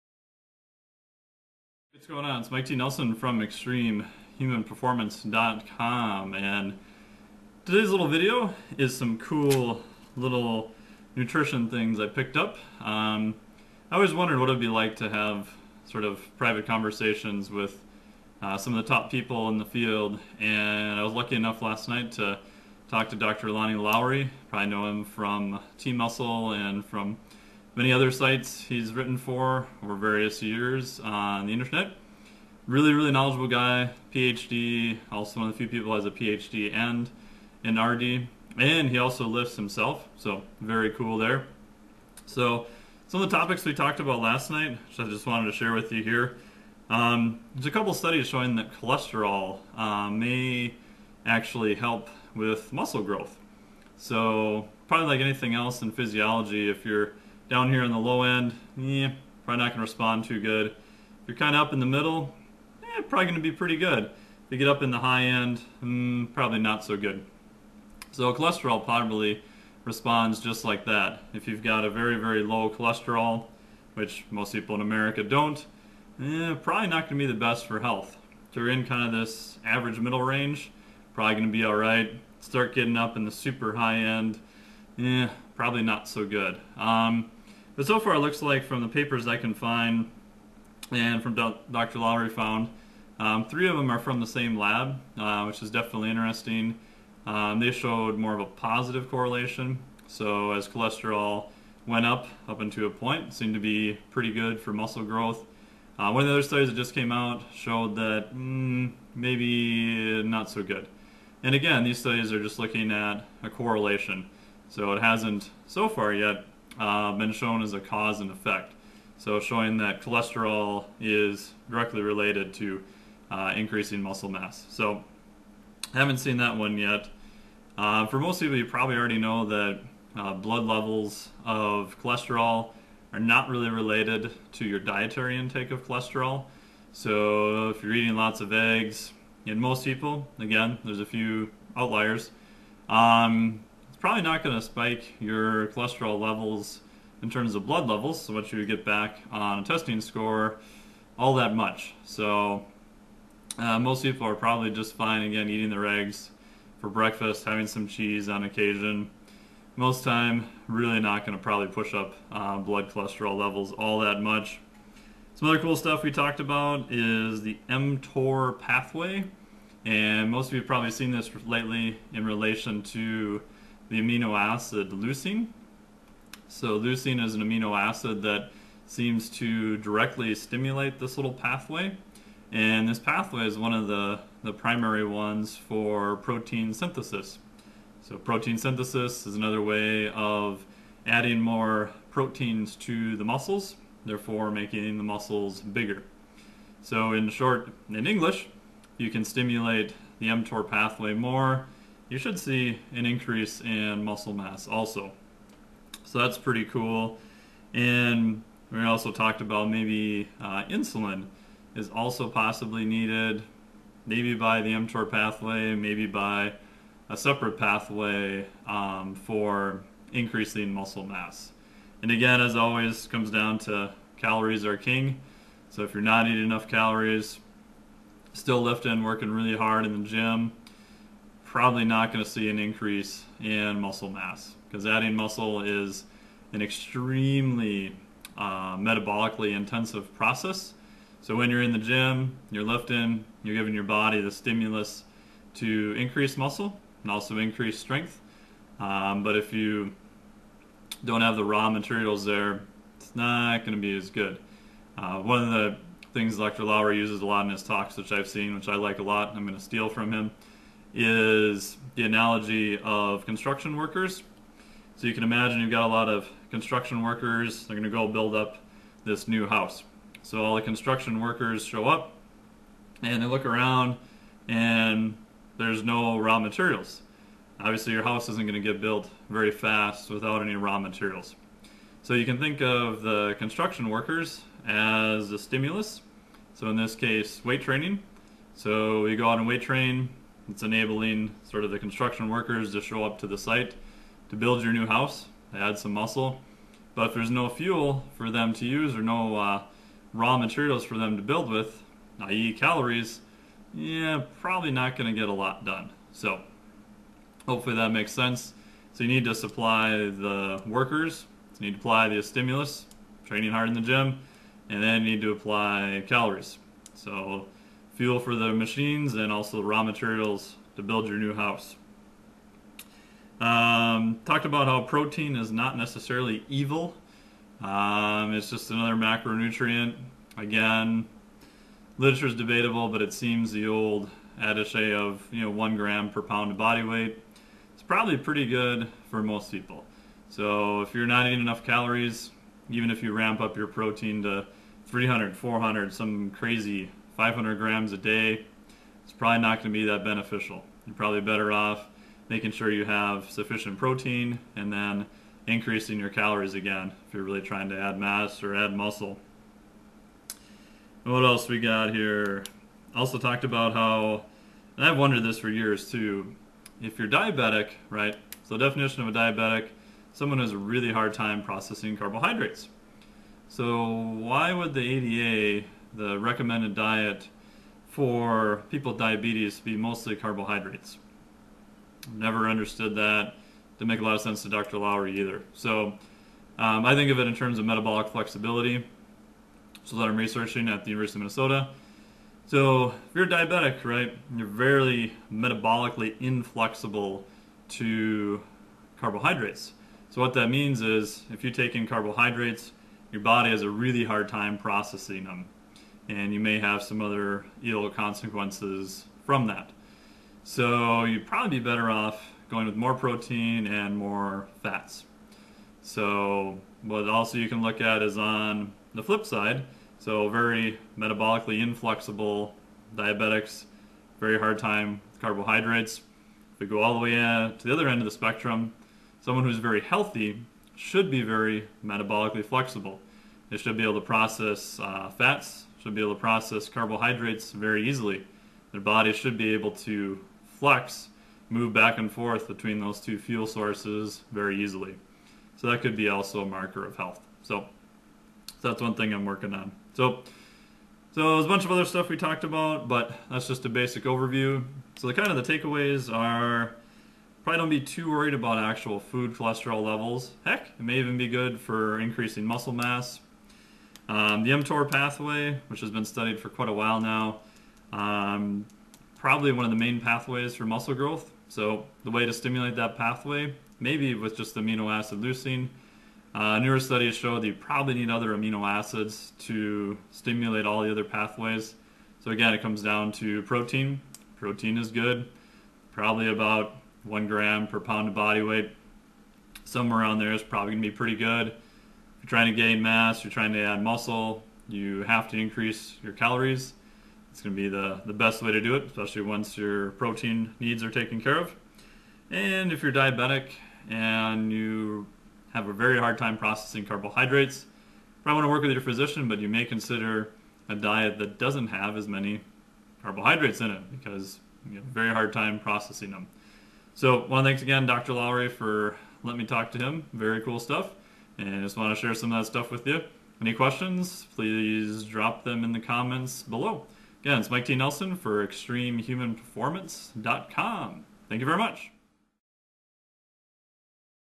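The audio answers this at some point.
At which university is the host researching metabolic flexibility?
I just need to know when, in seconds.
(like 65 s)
390 s.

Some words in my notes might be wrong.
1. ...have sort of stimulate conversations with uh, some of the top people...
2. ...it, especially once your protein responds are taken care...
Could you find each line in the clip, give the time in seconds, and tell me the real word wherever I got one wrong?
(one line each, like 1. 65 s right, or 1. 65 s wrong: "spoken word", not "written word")
1. 15 s wrong: "private", not "stimulate"
2. 498 s wrong: "needs", not "responds".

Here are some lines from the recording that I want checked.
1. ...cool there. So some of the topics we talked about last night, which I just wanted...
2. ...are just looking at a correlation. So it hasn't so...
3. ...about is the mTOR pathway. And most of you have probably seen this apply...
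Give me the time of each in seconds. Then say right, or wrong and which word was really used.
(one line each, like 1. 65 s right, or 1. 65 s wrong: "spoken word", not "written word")
1. 40 s right
2. 112 s right
3. 166 s wrong: "lately", not "apply".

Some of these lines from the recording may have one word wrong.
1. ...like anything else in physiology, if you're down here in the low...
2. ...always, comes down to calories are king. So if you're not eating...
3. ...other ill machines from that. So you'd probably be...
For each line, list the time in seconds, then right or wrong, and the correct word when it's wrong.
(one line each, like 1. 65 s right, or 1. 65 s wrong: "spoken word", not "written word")
1. 55 s right
2. 222 s right
3. 407 s wrong: "consequences", not "machines".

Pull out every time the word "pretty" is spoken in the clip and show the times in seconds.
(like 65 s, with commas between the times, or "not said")
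63 s, 104 s, 206 s, 338 s, 490 s.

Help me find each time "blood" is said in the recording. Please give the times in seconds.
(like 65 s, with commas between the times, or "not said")
130 s, 147 s, 162 s.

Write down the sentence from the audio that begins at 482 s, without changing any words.
So again, it comes down to protein.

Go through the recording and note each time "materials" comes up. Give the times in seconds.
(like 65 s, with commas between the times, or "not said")
251 s, 276 s, 280 s, 300 s, 319 s.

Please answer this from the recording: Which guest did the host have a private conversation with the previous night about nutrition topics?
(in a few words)
Dr. Lonnie Lowery.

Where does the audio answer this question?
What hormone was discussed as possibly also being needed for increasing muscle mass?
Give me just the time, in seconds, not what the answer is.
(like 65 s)
210 s.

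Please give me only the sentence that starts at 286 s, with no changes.
So in this case, weight training.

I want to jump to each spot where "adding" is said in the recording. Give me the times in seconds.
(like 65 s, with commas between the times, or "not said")
191 s, 234 s.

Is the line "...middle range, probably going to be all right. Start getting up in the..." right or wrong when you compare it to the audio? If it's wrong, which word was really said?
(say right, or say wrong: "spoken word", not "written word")
right.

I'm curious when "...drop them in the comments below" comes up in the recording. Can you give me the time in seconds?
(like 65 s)
525 s.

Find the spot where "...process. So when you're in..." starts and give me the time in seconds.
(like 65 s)
240 s.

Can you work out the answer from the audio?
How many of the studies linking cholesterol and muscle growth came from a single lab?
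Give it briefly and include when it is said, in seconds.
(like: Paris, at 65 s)
3, at 93 s.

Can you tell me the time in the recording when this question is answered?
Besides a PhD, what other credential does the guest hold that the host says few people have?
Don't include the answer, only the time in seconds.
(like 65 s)
37 s.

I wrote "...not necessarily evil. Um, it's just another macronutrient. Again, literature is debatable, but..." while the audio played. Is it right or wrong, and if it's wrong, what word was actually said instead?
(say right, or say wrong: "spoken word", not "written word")
right.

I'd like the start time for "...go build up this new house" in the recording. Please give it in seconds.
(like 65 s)
267 s.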